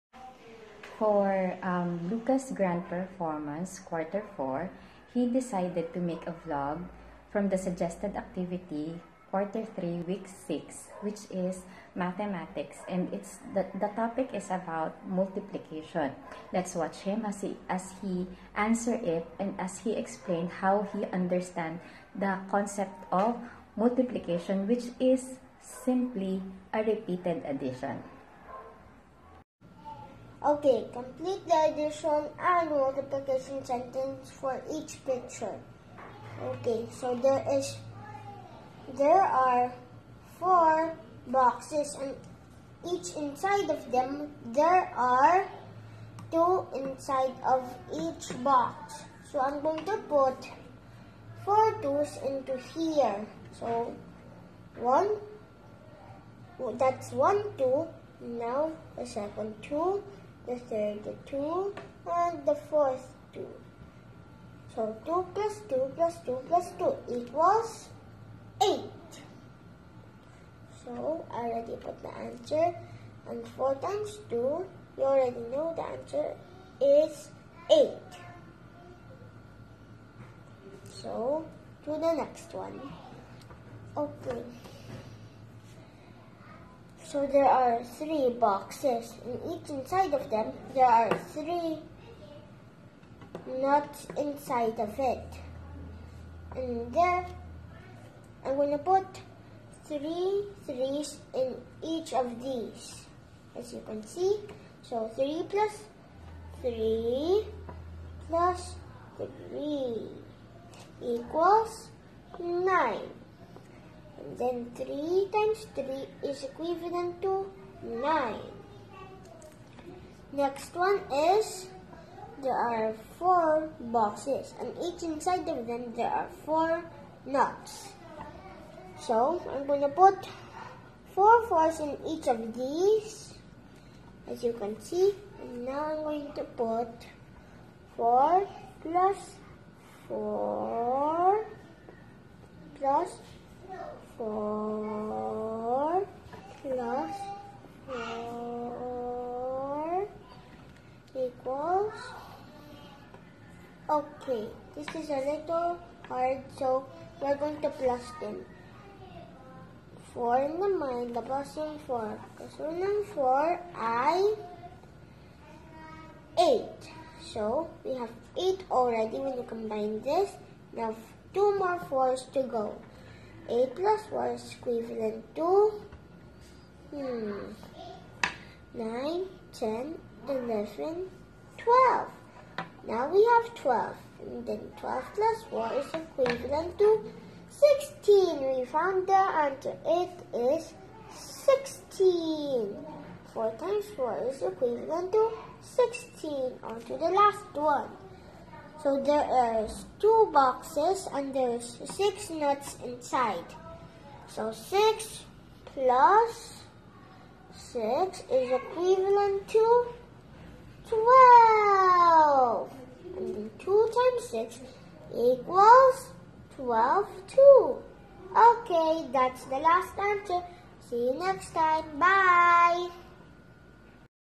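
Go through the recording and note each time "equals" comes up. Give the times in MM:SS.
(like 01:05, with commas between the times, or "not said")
01:07, 01:51, 02:31, 03:35.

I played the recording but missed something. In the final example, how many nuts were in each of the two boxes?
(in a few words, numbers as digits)
6.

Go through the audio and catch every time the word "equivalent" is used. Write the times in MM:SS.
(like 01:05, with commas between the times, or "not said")
01:56, 02:54, 03:05, 03:14, 03:28.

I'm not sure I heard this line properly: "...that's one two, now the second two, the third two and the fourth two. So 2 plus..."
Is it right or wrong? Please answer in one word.
right.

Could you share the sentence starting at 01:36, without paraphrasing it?
And there, I'm going to put three threes in each of these.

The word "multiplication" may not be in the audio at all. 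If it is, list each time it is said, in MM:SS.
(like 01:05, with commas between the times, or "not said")
00:15, 00:23, 00:32.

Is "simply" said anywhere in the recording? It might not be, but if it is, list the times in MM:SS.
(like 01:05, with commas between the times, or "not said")
00:25.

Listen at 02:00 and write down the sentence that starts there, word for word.
Next one is there are 4 boxes and each inside of them there are 4 nuts.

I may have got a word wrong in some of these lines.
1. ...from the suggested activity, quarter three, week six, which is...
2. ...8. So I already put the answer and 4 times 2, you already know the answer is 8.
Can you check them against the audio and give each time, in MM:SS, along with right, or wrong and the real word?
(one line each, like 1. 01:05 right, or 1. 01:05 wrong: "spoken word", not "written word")
1. 00:07 right
2. 01:08 right.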